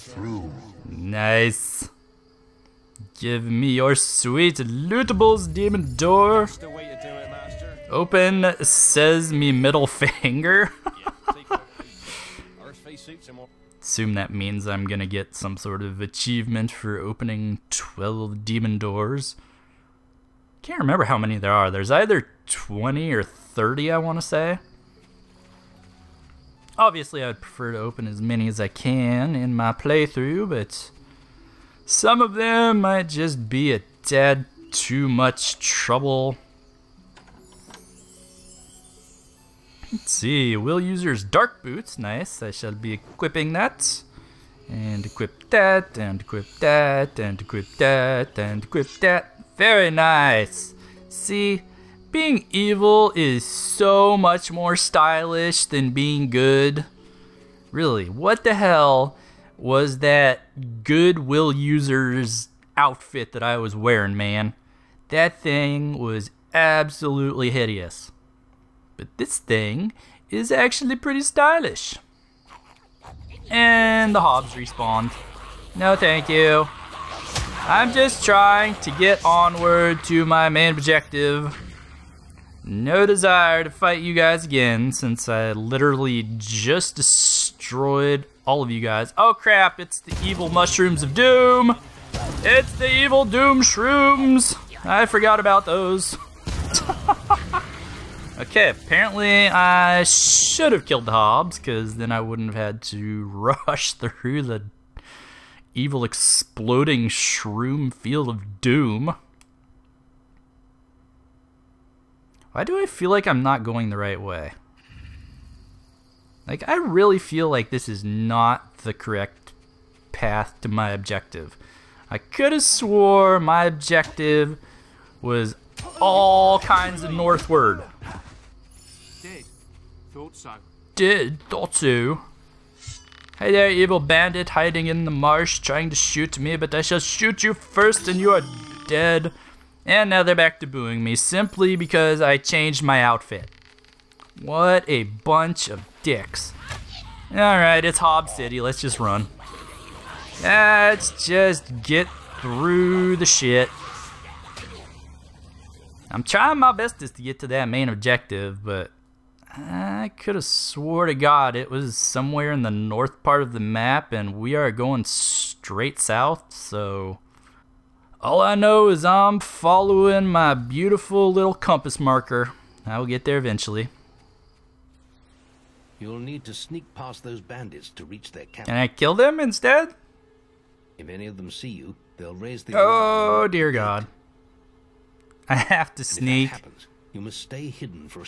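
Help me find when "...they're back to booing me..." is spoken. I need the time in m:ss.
2:20.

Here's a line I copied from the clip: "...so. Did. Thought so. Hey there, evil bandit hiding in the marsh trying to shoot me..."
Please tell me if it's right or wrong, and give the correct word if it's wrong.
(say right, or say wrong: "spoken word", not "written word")
right.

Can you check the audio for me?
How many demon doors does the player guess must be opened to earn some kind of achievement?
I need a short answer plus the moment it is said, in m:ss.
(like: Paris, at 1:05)
12, at 0:17.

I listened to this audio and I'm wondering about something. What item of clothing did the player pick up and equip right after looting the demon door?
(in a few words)
Dark boots.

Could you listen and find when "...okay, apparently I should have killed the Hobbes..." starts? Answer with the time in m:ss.
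1:38.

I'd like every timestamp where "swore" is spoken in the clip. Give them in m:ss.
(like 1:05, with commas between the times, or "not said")
2:02, 2:40.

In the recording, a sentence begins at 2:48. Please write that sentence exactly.
All I know is I'm following my beautiful little compass marker.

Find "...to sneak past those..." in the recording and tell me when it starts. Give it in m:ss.
2:56.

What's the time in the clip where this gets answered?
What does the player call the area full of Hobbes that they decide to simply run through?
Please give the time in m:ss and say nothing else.
2:27.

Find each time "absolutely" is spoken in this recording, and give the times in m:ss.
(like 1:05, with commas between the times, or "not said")
1:06.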